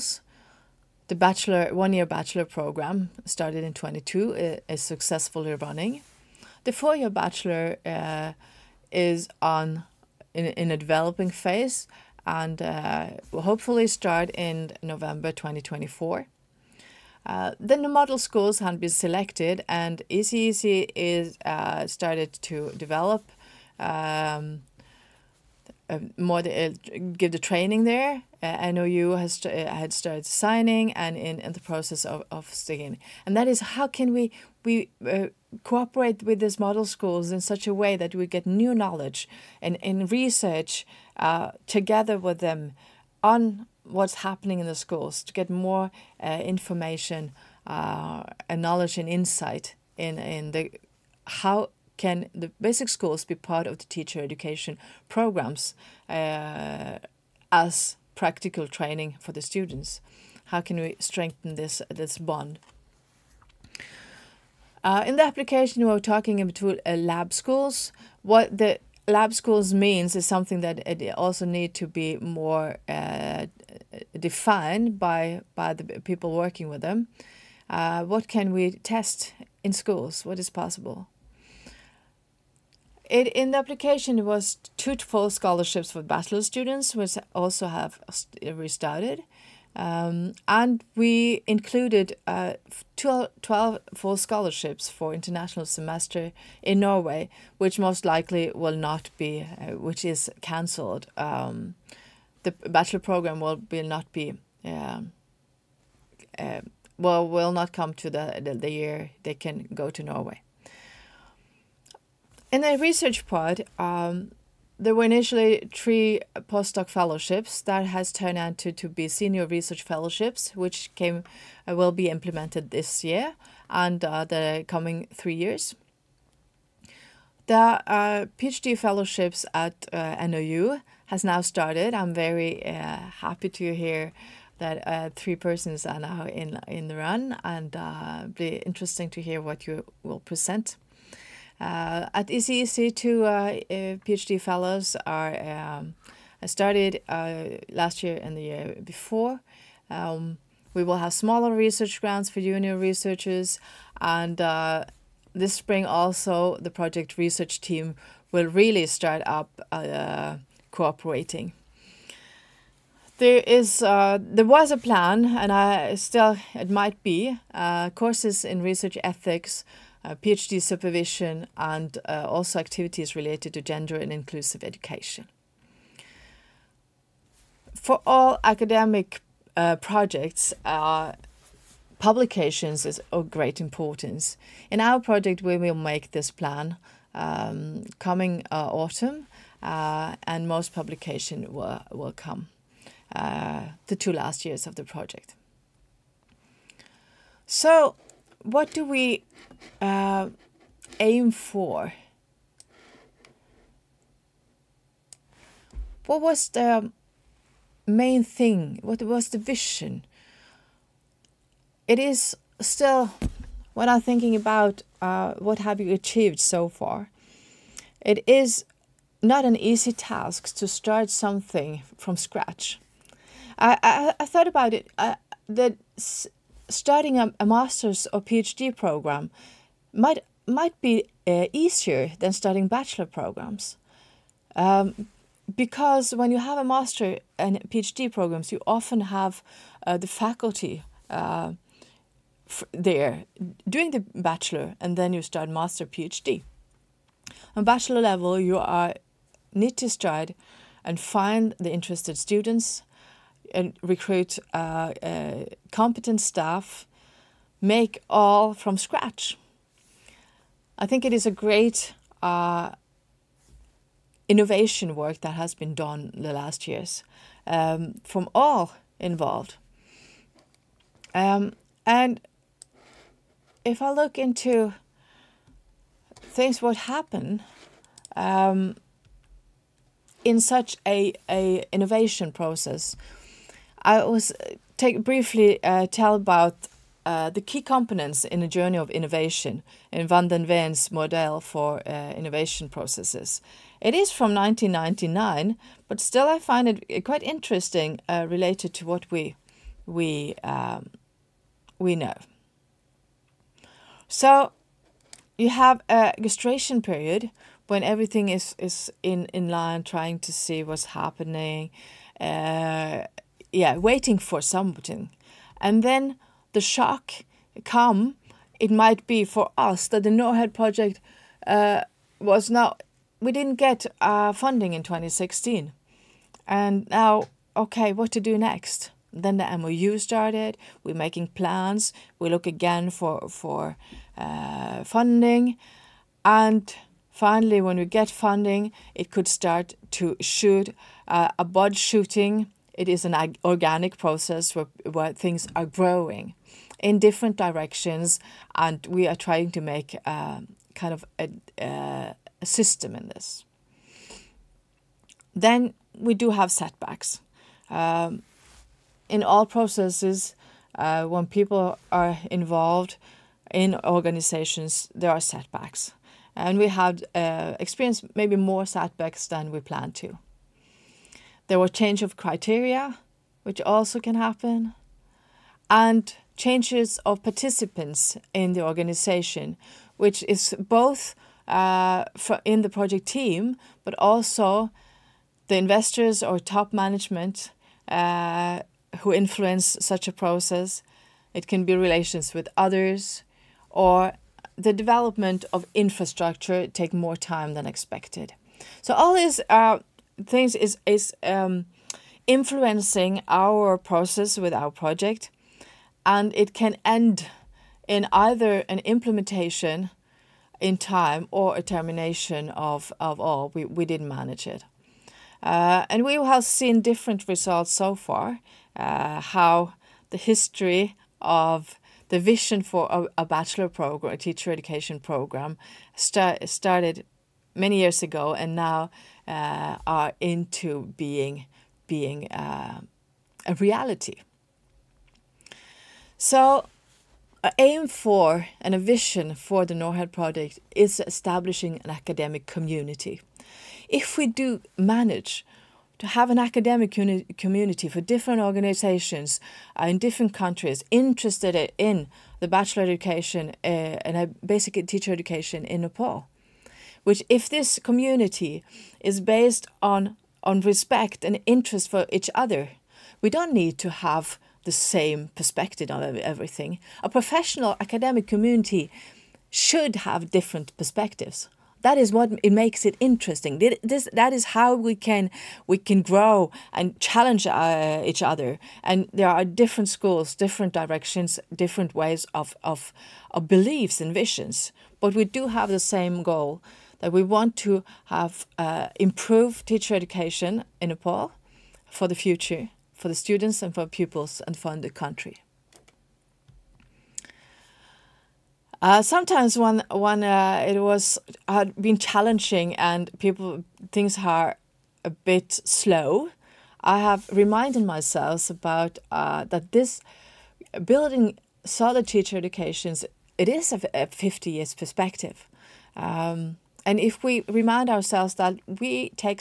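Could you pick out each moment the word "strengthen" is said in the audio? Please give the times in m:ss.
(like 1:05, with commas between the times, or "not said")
1:00.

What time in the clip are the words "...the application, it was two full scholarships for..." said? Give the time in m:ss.
1:23.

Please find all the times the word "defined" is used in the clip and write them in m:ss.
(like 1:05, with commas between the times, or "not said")
1:14.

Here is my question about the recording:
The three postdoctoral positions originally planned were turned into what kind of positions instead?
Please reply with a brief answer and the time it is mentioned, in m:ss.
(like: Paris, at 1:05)
Senior research fellowships, at 1:59.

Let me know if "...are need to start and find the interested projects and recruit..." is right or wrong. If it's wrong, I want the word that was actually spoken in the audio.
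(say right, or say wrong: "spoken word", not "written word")
wrong: "students", not "projects".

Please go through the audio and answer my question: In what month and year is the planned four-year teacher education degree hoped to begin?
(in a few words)
November 2024.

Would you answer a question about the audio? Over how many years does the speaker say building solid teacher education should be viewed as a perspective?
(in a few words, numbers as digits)
50 years.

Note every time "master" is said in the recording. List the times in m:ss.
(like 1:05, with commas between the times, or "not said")
3:47, 3:56, 4:05.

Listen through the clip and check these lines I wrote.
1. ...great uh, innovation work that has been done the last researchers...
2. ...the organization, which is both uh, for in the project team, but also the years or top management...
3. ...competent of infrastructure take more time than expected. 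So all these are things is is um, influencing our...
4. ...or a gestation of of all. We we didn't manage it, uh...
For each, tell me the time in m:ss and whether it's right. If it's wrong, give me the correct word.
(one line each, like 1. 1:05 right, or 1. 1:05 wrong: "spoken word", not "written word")
1. 4:21 wrong: "years", not "researchers"
2. 6:18 wrong: "investors", not "years"
3. 6:34 wrong: "development", not "competent"
4. 6:51 wrong: "termination", not "gestation".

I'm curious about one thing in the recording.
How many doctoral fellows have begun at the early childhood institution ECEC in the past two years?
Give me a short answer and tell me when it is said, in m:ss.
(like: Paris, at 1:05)
2, at 2:22.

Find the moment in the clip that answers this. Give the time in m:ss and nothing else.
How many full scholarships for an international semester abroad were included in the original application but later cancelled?
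1:32.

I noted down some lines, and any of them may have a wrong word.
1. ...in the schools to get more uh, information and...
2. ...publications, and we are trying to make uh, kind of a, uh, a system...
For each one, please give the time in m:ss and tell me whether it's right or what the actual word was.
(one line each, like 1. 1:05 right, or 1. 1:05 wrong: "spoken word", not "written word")
1. 0:44 right
2. 5:47 wrong: "directions", not "publications".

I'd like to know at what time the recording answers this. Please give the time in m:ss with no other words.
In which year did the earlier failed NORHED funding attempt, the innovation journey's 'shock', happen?
5:24.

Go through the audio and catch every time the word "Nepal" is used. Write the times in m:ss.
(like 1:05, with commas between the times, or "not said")
7:35, 8:10.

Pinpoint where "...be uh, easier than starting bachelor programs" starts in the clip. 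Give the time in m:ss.
3:50.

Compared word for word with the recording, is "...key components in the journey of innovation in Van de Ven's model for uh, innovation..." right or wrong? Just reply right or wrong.
right.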